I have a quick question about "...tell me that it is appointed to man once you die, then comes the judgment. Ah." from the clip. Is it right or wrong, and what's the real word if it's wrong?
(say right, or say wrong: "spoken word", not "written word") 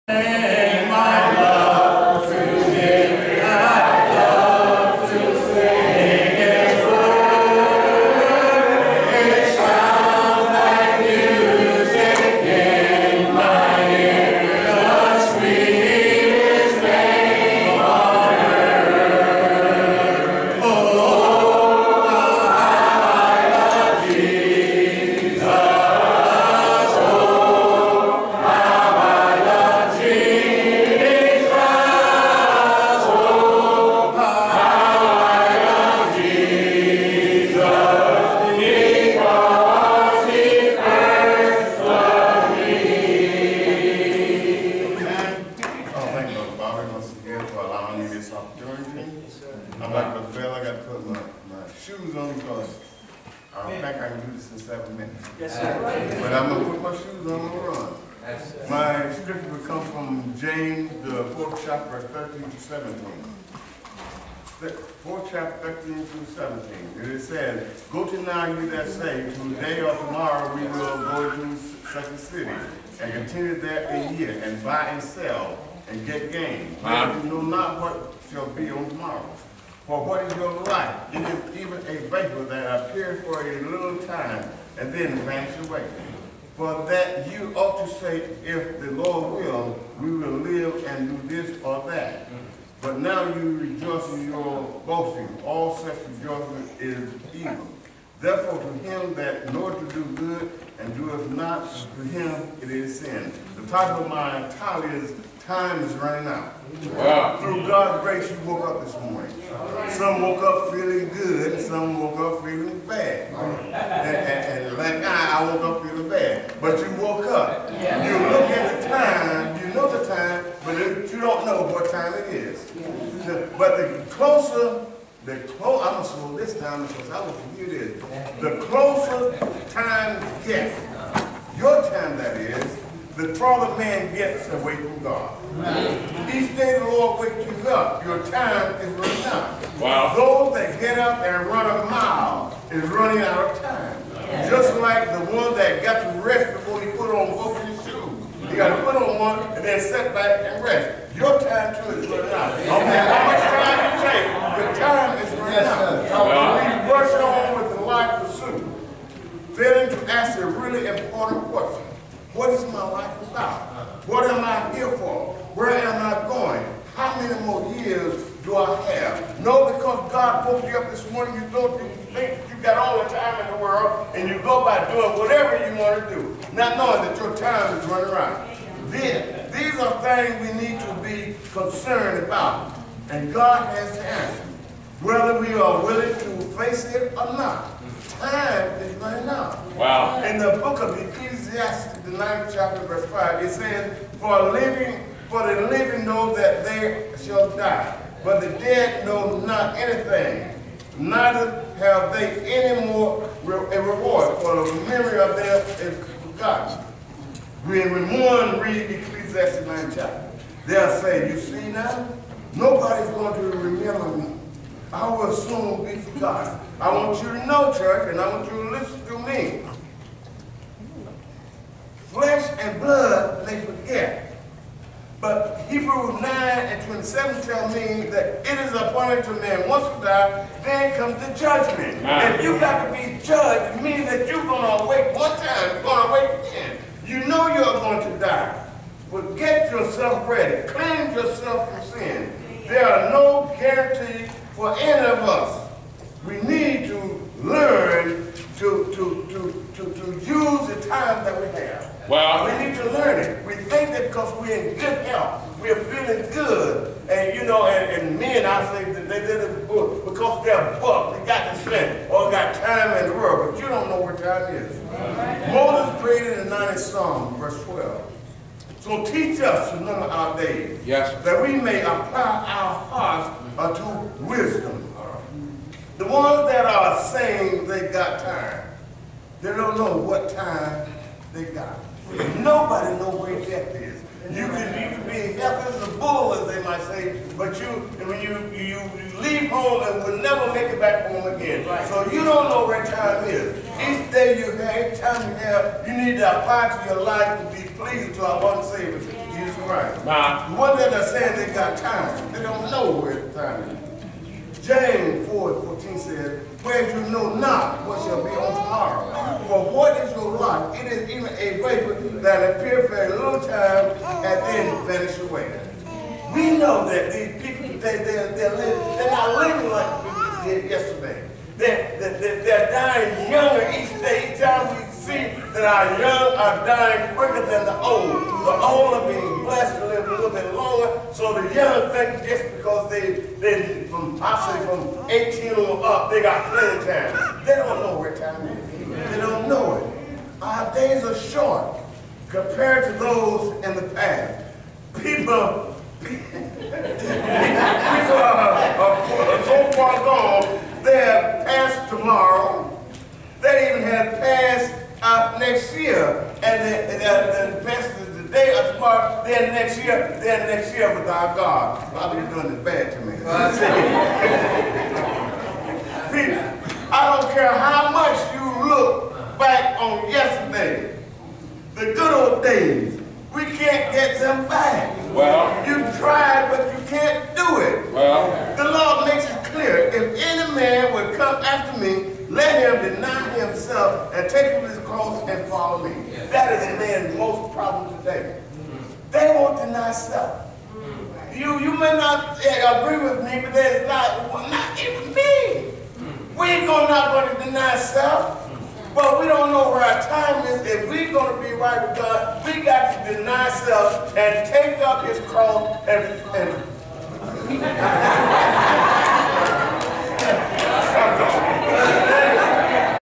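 right.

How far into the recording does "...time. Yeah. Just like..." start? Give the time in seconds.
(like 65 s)
143 s.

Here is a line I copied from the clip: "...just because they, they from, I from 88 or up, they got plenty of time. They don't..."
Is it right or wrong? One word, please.
wrong.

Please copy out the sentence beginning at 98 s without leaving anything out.
Therefore to him that knoweth to do good and doeth not, to him it is sin.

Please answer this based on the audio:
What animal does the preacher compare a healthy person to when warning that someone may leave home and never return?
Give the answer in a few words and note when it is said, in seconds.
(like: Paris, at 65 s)
a bull, at 285 s.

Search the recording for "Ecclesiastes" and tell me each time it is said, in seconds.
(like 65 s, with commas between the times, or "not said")
190 s, 208 s.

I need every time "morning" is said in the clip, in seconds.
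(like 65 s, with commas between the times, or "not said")
109 s, 171 s.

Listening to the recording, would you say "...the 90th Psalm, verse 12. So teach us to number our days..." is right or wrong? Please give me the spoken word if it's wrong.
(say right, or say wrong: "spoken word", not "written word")
right.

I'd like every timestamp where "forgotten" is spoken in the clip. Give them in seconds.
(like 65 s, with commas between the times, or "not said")
206 s, 216 s.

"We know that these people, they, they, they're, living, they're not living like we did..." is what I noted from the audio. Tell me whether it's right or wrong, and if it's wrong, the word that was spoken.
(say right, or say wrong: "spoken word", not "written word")
right.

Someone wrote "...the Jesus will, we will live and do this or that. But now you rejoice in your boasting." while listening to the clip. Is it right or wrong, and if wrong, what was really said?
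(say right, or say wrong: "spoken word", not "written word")
wrong: "Lord", not "Jesus".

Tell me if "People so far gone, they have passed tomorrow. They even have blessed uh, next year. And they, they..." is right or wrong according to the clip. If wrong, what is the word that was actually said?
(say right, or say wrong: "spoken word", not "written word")
wrong: "passed", not "blessed".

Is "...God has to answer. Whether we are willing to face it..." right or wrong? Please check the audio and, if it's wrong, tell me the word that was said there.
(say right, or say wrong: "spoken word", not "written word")
right.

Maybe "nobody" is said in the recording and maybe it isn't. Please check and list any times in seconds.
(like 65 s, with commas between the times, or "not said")
212 s, 282 s.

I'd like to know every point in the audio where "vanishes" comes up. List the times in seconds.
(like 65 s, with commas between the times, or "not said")
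85 s, 314 s.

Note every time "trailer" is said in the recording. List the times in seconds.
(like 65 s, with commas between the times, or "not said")
not said.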